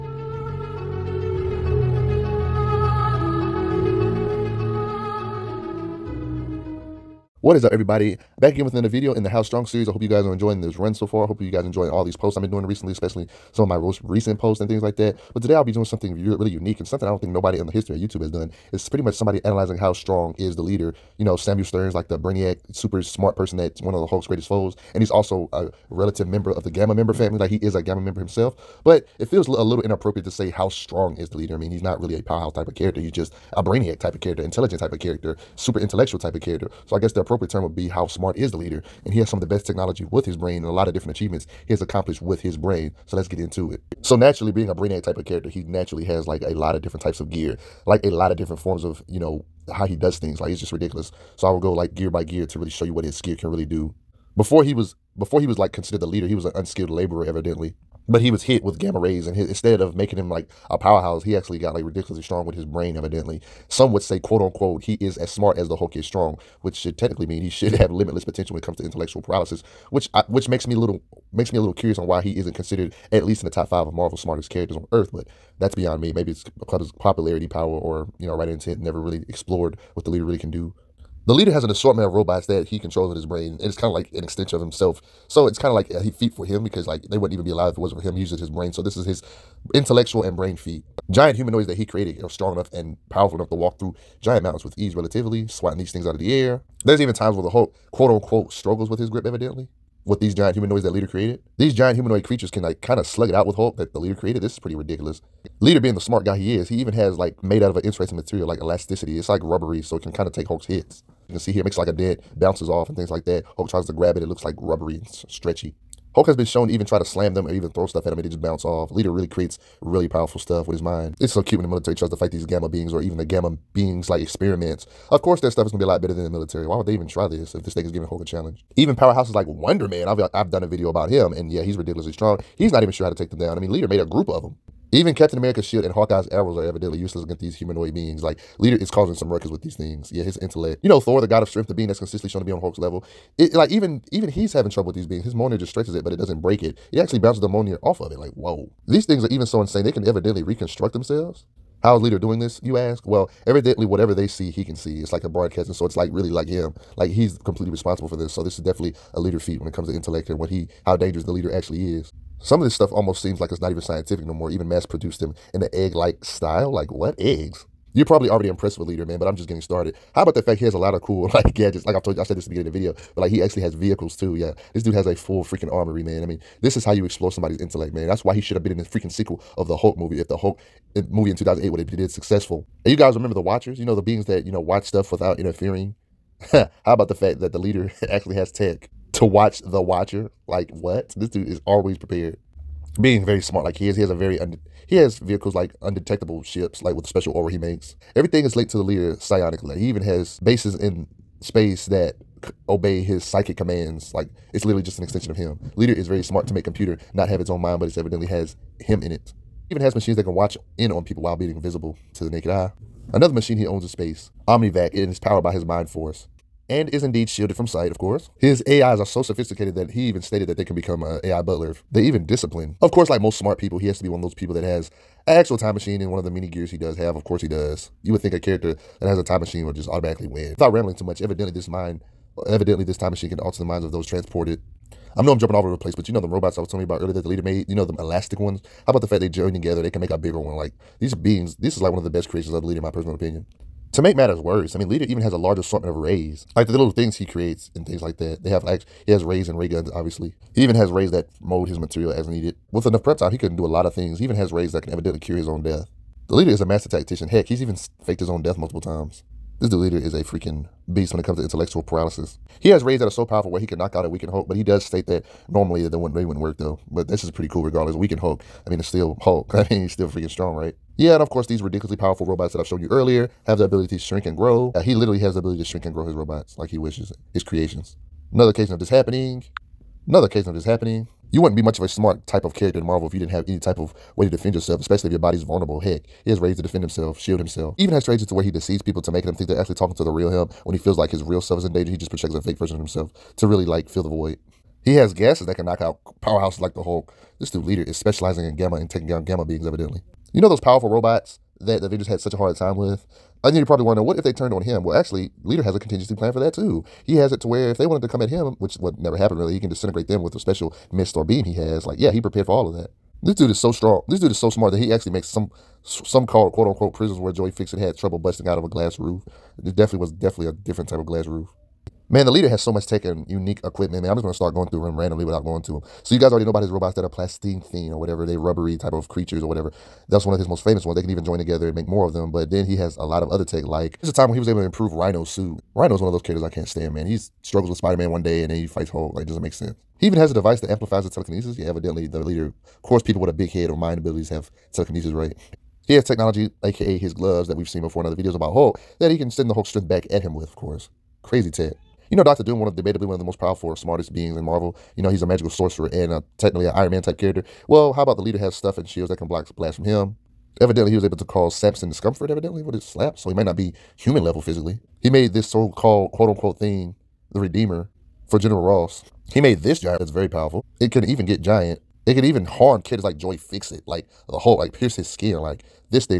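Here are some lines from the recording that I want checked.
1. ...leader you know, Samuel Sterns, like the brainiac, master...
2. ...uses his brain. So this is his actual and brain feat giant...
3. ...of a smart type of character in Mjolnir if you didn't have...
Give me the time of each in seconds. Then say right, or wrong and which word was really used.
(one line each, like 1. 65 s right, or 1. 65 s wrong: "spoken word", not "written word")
1. 20 s wrong: "super", not "master"
2. 88 s wrong: "intellectual", not "actual"
3. 281 s wrong: "Marvel", not "Mjolnir".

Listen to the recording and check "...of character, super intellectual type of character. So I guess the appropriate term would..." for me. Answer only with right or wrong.
right.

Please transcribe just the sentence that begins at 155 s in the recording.
It's like a broadcast, and so it's like really like him.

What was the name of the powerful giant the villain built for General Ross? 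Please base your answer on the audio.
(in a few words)
the Redeemer.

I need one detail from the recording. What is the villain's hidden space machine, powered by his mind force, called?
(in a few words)
Omnivac.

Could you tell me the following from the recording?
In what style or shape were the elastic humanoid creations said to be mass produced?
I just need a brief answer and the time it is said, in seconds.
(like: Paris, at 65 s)
egg-like, at 165 s.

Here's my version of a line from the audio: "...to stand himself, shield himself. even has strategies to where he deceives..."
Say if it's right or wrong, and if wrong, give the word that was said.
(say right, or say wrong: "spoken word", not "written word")
wrong: "defend", not "stand".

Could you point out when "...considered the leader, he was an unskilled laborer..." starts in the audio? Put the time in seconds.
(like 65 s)
55 s.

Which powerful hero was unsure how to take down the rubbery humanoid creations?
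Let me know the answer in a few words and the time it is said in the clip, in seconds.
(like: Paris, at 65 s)
Wonder Man, at 129 s.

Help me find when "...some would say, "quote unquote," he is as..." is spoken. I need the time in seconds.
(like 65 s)
63 s.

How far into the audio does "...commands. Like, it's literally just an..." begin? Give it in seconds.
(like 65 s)
203 s.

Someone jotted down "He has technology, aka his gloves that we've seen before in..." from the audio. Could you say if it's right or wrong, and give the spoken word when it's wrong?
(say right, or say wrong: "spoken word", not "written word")
right.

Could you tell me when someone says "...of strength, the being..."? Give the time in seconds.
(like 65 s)
141 s.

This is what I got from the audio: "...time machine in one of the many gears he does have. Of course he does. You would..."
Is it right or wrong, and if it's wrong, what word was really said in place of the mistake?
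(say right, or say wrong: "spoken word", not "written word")
right.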